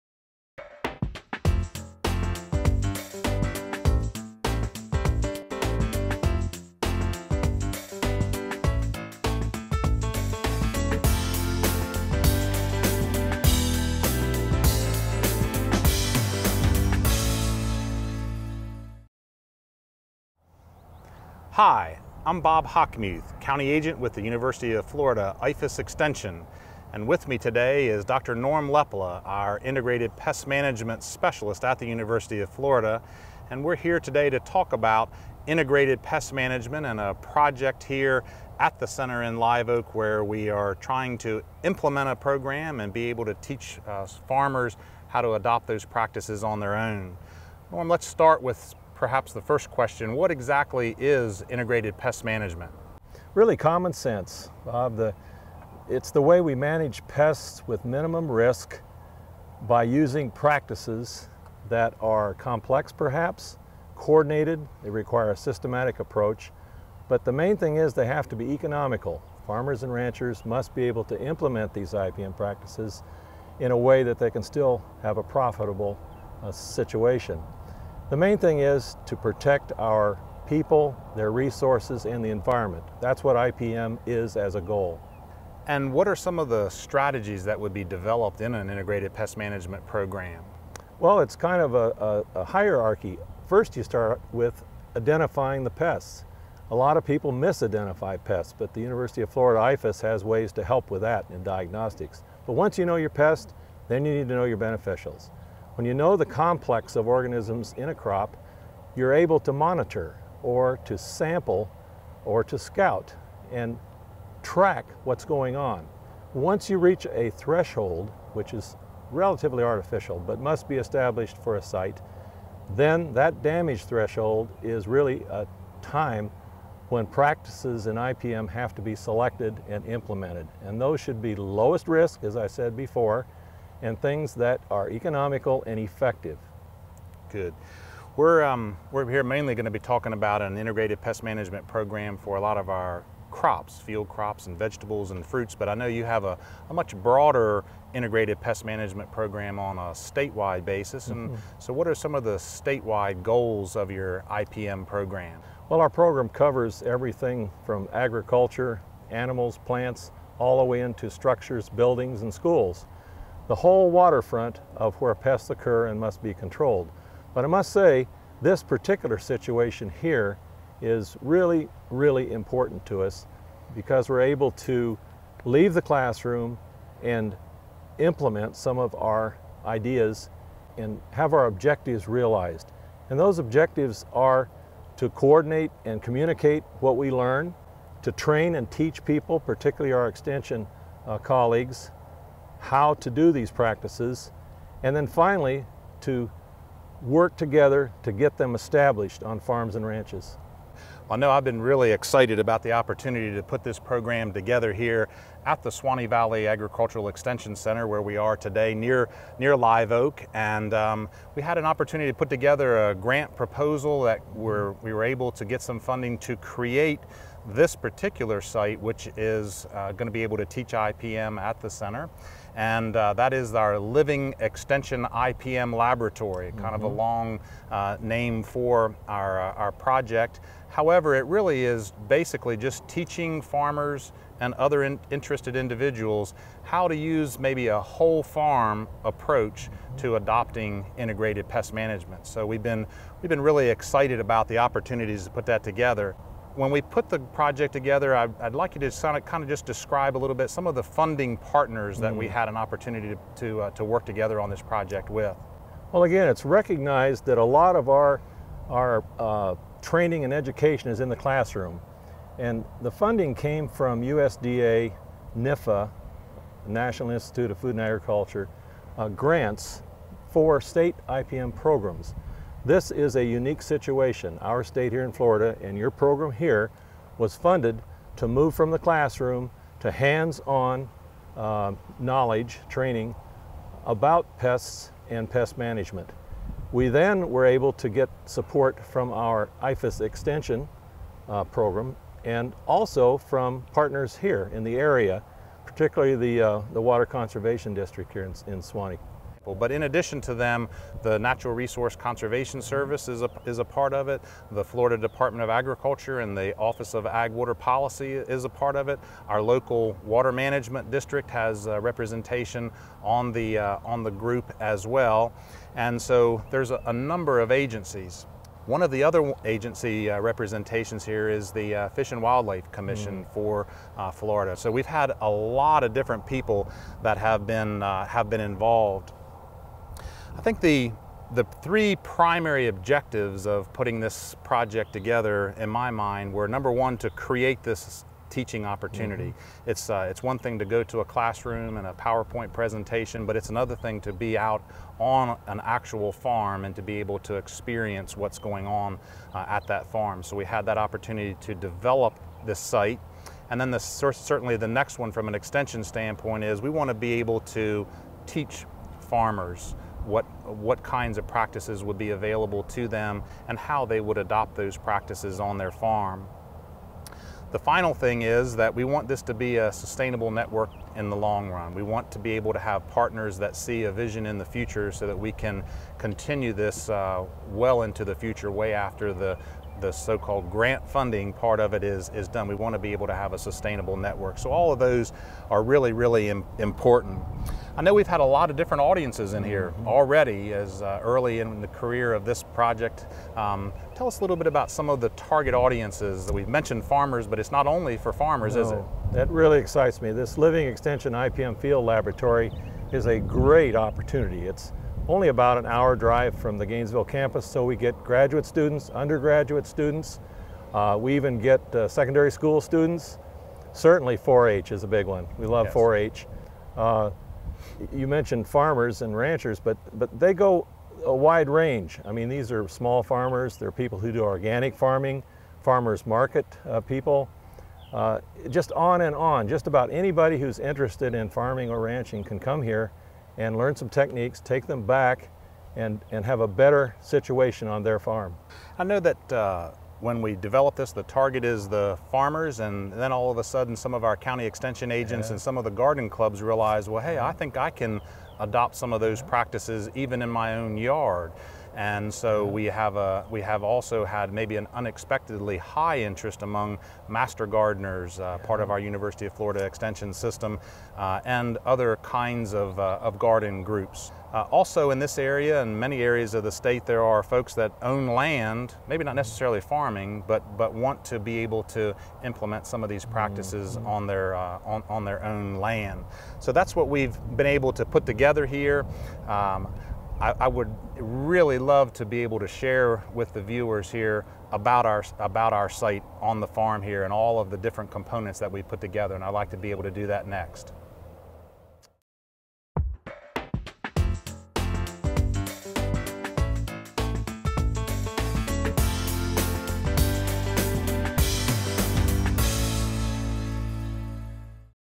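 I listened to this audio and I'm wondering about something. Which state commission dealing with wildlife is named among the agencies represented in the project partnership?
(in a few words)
Fish and Wildlife Commission.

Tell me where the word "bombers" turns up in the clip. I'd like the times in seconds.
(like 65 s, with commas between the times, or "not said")
not said.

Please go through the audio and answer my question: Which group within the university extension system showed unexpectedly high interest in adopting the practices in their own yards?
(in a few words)
master gardeners.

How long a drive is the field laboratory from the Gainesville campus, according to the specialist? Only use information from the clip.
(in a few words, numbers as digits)
about an hour.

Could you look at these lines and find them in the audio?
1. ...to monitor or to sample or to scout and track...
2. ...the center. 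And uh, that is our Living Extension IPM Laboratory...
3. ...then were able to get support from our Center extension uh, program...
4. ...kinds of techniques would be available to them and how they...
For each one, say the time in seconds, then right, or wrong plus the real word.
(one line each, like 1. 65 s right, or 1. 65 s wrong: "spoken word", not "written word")
1. 109 s right
2. 221 s right
3. 286 s wrong: "IFAS", not "Center"
4. 360 s wrong: "practices", not "techniques".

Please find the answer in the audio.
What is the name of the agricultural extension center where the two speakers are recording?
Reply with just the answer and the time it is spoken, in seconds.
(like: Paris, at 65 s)
Suwannee Valley Agricultural Extension Center, at 205 s.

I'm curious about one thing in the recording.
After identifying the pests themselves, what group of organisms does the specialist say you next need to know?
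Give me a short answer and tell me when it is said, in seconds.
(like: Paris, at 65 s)
beneficials, at 104 s.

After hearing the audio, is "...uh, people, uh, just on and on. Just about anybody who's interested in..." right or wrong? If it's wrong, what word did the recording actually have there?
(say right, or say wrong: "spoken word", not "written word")
right.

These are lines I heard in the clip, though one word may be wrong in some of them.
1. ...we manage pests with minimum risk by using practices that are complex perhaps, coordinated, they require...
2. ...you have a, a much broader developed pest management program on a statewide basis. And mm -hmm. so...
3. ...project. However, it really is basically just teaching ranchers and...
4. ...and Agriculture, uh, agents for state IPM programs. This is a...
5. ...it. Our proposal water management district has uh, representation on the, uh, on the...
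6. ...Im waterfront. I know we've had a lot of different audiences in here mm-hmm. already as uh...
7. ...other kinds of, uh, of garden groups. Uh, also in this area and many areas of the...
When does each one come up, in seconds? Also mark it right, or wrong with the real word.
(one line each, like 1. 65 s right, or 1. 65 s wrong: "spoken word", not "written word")
1. 56 s right
2. 145 s wrong: "integrated", not "developed"
3. 229 s wrong: "farmers", not "ranchers"
4. 267 s wrong: "grants", not "agents"
5. 308 s wrong: "local", not "proposal"
6. 386 s wrong: "important", not "waterfront"
7. 461 s right.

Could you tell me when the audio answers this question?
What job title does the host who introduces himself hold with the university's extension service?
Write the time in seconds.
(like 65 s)
23 s.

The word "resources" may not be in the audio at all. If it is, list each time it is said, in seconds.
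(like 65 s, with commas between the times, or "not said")
81 s, 301 s.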